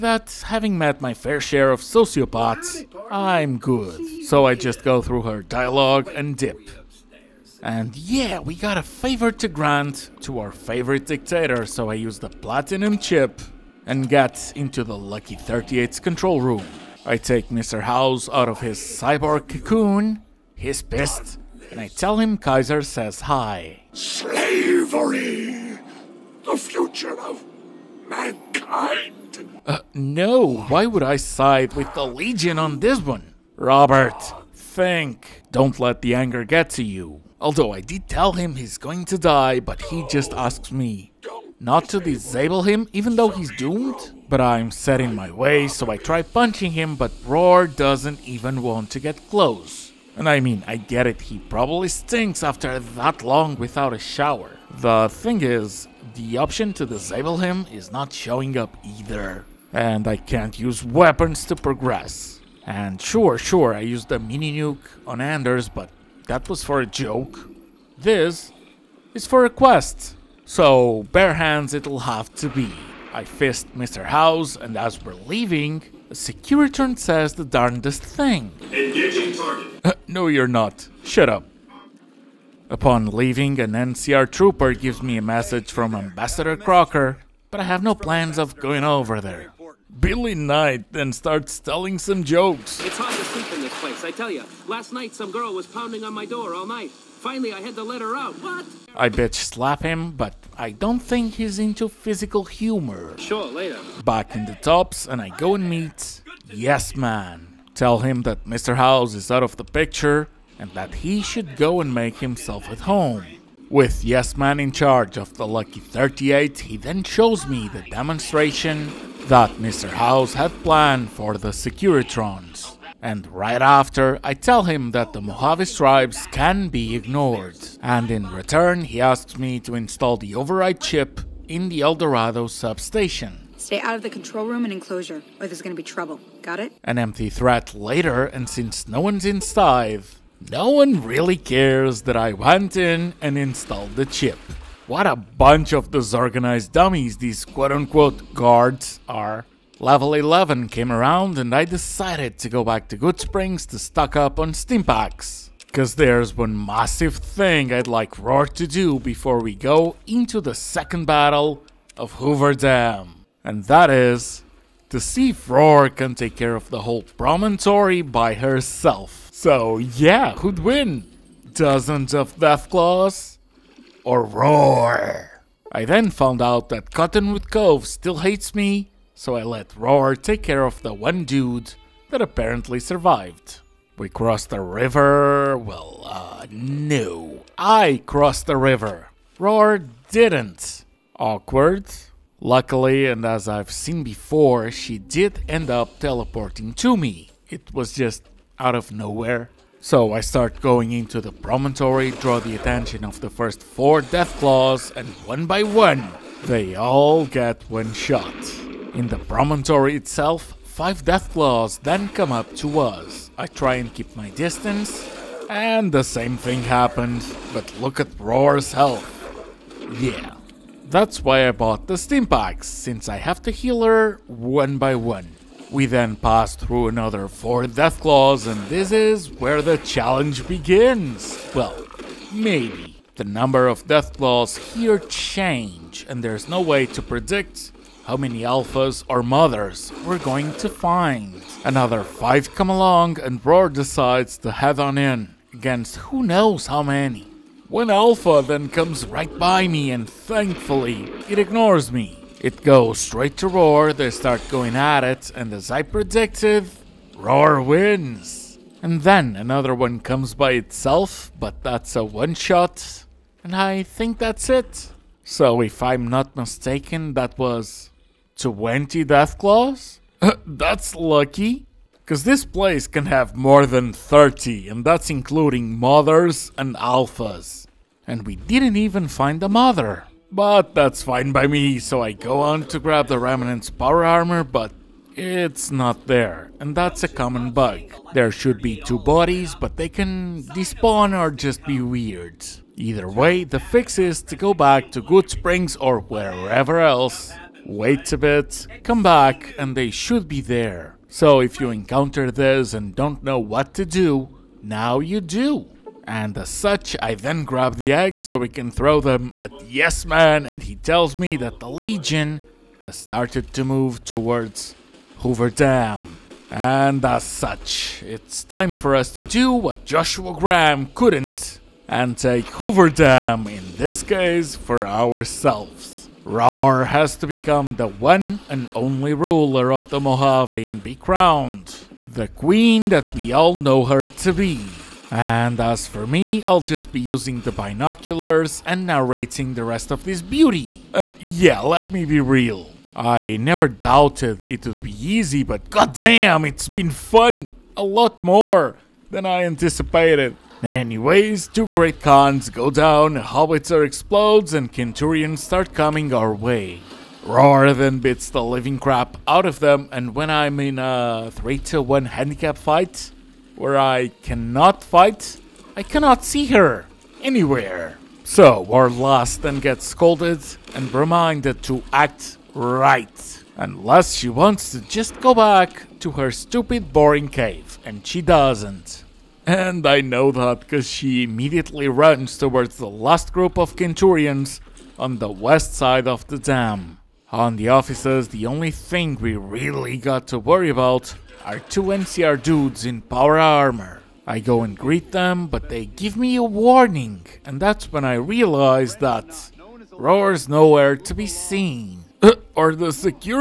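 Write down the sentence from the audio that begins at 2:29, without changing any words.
Level 11 came around and I decided to go back to Goodsprings to stock up on stimpaks.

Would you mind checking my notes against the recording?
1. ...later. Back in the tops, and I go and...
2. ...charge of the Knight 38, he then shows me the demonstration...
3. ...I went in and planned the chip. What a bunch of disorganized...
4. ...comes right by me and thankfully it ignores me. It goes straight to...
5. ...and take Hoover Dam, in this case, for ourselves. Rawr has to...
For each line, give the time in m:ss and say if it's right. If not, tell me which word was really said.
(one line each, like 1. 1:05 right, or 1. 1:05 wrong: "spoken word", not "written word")
1. 1:43 right
2. 1:54 wrong: "Lucky", not "Knight"
3. 2:22 wrong: "installed", not "planned"
4. 4:08 right
5. 5:21 right.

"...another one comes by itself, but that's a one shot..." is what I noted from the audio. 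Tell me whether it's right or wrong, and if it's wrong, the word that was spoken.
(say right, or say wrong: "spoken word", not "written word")
right.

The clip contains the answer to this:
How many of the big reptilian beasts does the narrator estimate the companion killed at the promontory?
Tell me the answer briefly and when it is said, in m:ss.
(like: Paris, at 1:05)
20, at 4:28.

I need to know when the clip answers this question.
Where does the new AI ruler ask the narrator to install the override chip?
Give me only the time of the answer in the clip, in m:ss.
2:11.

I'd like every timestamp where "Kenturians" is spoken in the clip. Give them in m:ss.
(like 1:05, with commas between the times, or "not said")
5:54, 6:23.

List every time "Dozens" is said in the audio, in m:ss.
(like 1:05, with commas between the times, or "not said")
2:51.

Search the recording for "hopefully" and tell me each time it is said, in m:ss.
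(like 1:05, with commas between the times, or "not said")
not said.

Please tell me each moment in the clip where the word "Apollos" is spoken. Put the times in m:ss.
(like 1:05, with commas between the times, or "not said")
not said.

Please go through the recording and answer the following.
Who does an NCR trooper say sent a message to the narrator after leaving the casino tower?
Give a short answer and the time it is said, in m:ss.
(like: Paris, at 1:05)
Ambassador Crocker, at 1:25.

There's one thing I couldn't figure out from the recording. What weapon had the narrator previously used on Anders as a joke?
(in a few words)
Mini nuke.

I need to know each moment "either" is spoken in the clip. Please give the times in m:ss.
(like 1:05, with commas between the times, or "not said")
0:58, 4:52.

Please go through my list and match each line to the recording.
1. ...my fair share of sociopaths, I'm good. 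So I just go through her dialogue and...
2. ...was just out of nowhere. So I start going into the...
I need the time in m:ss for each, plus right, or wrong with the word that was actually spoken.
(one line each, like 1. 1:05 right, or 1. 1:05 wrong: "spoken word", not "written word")
1. 0:00 right
2. 3:17 right.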